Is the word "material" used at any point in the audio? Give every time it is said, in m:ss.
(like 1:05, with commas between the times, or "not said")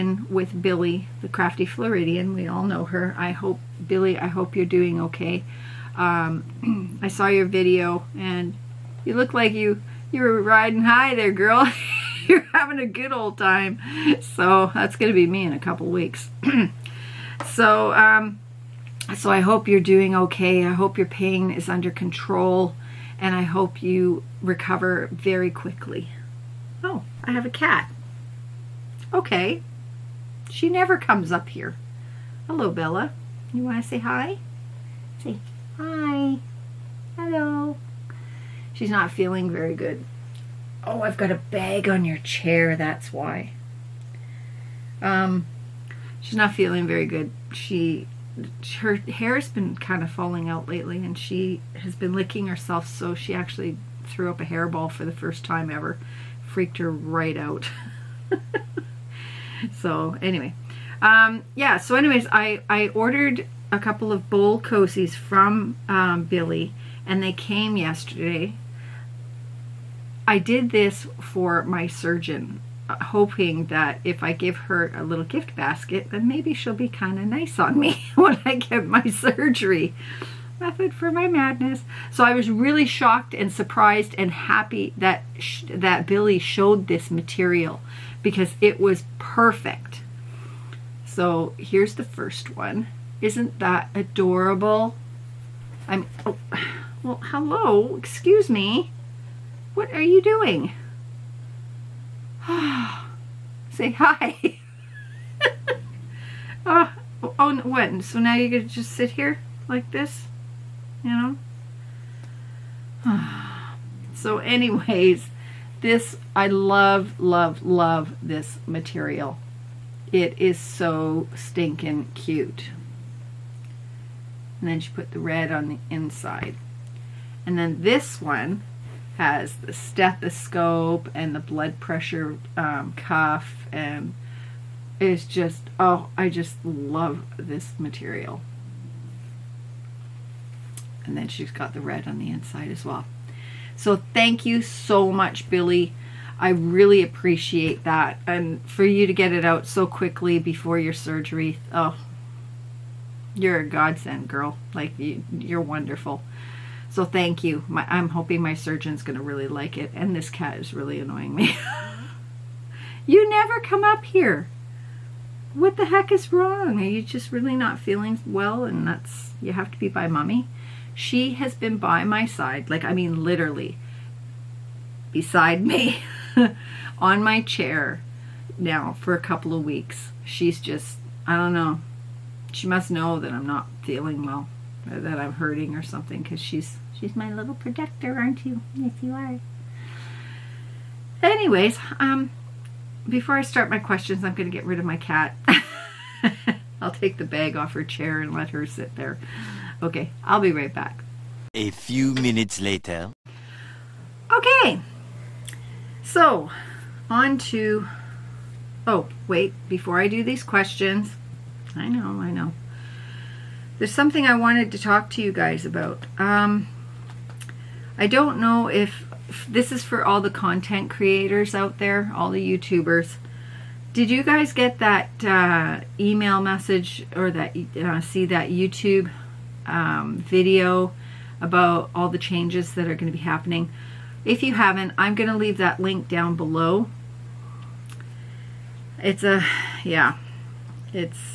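1:27, 1:58, 2:17.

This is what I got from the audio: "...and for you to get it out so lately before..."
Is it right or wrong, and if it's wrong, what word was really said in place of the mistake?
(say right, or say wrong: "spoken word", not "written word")
wrong: "quickly", not "lately".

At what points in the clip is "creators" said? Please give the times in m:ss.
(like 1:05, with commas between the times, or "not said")
3:40.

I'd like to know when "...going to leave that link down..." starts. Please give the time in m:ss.
3:55.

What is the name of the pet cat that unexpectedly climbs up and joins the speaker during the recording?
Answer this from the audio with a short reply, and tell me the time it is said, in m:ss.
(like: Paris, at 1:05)
Bella, at 0:32.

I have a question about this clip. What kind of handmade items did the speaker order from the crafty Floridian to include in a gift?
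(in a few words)
bowl cozies.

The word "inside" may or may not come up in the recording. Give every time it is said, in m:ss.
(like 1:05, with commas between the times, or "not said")
2:05, 2:22.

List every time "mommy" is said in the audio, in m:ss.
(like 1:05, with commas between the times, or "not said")
2:50.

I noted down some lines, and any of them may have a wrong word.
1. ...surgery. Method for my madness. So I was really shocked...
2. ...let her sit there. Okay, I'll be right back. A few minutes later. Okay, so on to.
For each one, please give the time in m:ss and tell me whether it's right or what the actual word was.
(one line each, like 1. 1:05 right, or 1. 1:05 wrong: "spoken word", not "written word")
1. 1:19 right
2. 3:18 right.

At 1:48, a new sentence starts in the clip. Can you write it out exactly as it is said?
So now you're going to just sit here like this?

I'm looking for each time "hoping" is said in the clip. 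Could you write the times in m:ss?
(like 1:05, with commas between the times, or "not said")
1:12, 2:38.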